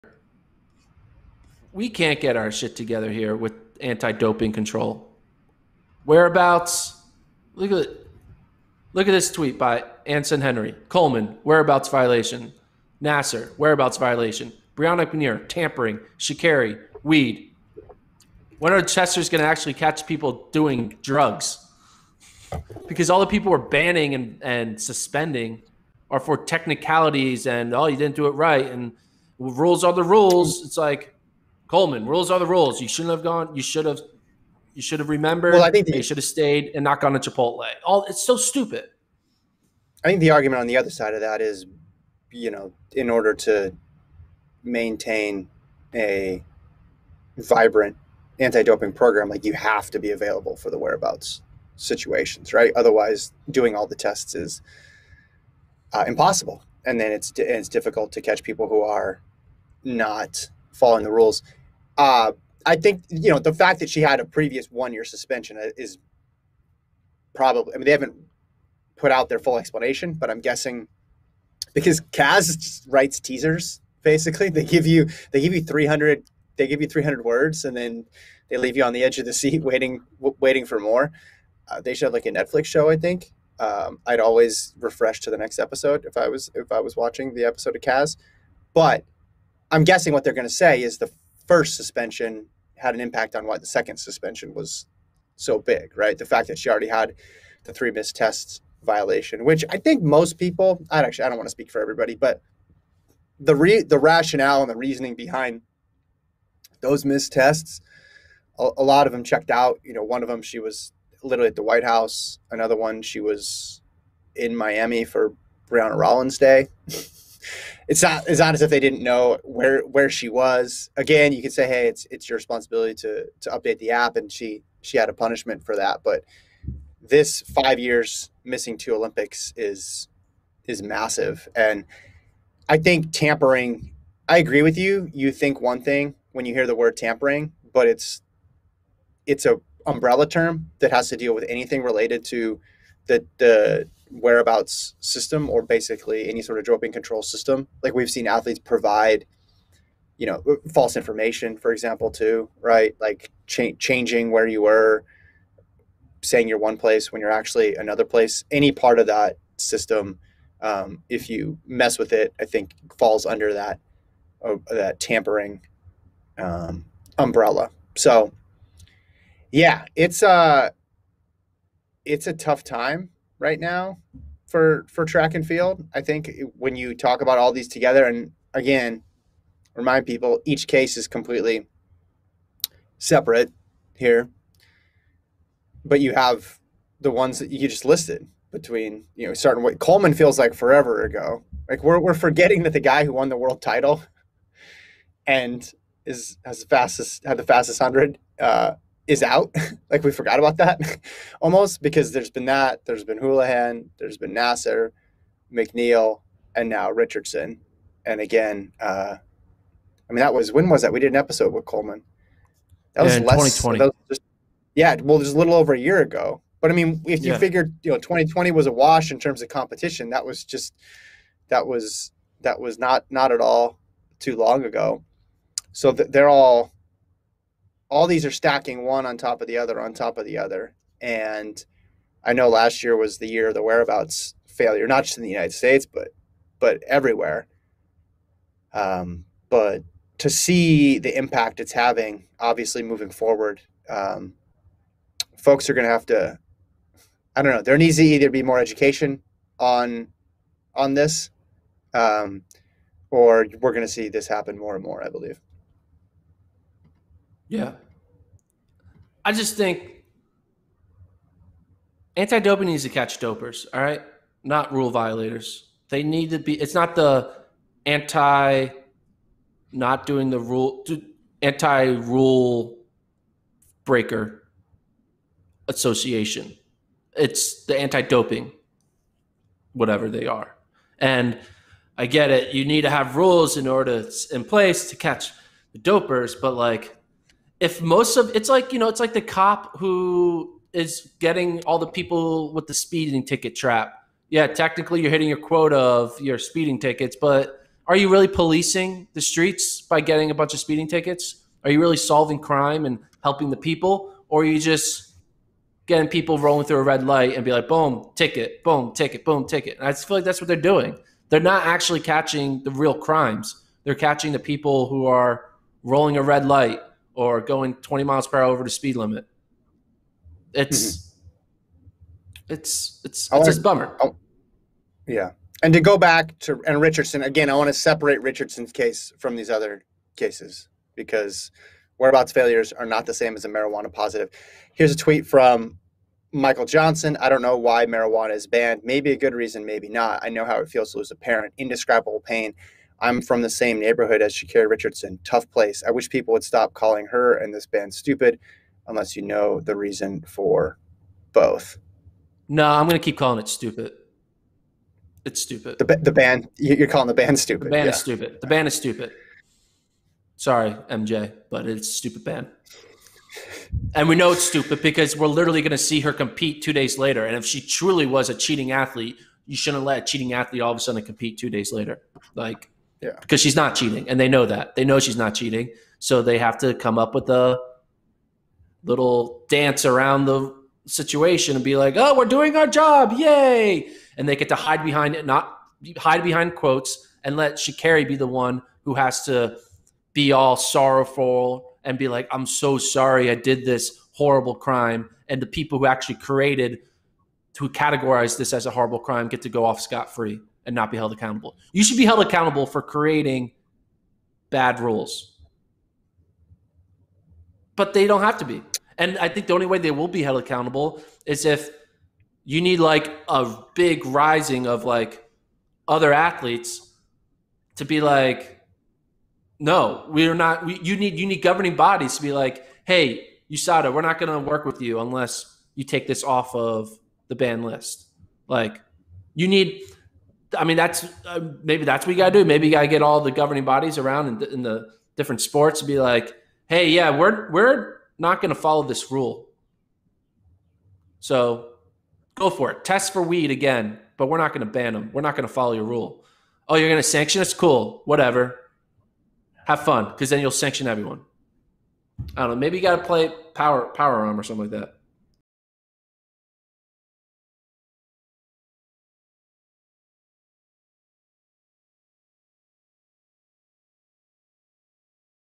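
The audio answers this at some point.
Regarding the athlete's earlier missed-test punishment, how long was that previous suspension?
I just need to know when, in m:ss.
1:04.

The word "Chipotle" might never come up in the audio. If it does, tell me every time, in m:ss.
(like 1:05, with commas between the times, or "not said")
0:37.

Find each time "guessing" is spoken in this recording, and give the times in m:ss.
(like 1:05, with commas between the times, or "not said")
1:10, 1:29.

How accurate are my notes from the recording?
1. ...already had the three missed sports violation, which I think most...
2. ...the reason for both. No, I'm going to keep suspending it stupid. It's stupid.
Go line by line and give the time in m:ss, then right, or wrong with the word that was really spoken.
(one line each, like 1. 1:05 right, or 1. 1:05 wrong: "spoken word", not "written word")
1. 1:36 wrong: "tests", not "sports"
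2. 5:49 wrong: "calling", not "suspending".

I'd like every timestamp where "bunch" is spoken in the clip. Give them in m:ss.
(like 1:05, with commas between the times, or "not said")
5:00.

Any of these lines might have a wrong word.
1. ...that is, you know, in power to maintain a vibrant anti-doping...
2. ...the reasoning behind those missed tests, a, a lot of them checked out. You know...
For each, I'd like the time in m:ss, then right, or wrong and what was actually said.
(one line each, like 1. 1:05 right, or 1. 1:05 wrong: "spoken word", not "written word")
1. 0:41 wrong: "order", not "power"
2. 1:44 right.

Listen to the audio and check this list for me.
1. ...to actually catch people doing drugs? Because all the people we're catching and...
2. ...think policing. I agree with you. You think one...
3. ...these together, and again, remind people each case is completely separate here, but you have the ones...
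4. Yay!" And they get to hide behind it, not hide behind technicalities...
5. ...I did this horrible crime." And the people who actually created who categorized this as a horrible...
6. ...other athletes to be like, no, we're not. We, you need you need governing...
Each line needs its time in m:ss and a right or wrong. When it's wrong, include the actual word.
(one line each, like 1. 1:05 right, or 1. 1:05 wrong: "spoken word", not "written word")
1. 0:19 wrong: "banning", not "catching"
2. 2:12 wrong: "tampering", not "policing"
3. 2:57 right
4. 6:23 wrong: "quotes", not "technicalities"
5. 6:33 right
6. 6:55 right.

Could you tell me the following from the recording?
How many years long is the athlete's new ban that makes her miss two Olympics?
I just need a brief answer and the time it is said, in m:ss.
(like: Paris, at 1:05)
5, at 2:07.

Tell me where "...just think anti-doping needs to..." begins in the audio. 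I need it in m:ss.
4:19.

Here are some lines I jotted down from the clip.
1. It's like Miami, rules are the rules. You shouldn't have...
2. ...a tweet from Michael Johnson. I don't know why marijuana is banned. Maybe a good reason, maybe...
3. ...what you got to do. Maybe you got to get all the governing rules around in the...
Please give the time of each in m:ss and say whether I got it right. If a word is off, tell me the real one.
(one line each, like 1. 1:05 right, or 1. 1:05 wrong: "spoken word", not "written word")
1. 0:30 wrong: "Coleman", not "Miami"
2. 5:34 right
3. 7:12 wrong: "bodies", not "rules".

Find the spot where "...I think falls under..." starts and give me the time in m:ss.
2:42.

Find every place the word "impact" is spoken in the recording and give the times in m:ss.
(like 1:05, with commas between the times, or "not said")
1:33, 4:01.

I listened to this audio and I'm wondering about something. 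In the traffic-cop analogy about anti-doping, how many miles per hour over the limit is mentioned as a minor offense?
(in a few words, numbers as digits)
20.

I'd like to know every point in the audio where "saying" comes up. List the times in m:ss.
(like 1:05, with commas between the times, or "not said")
2:36.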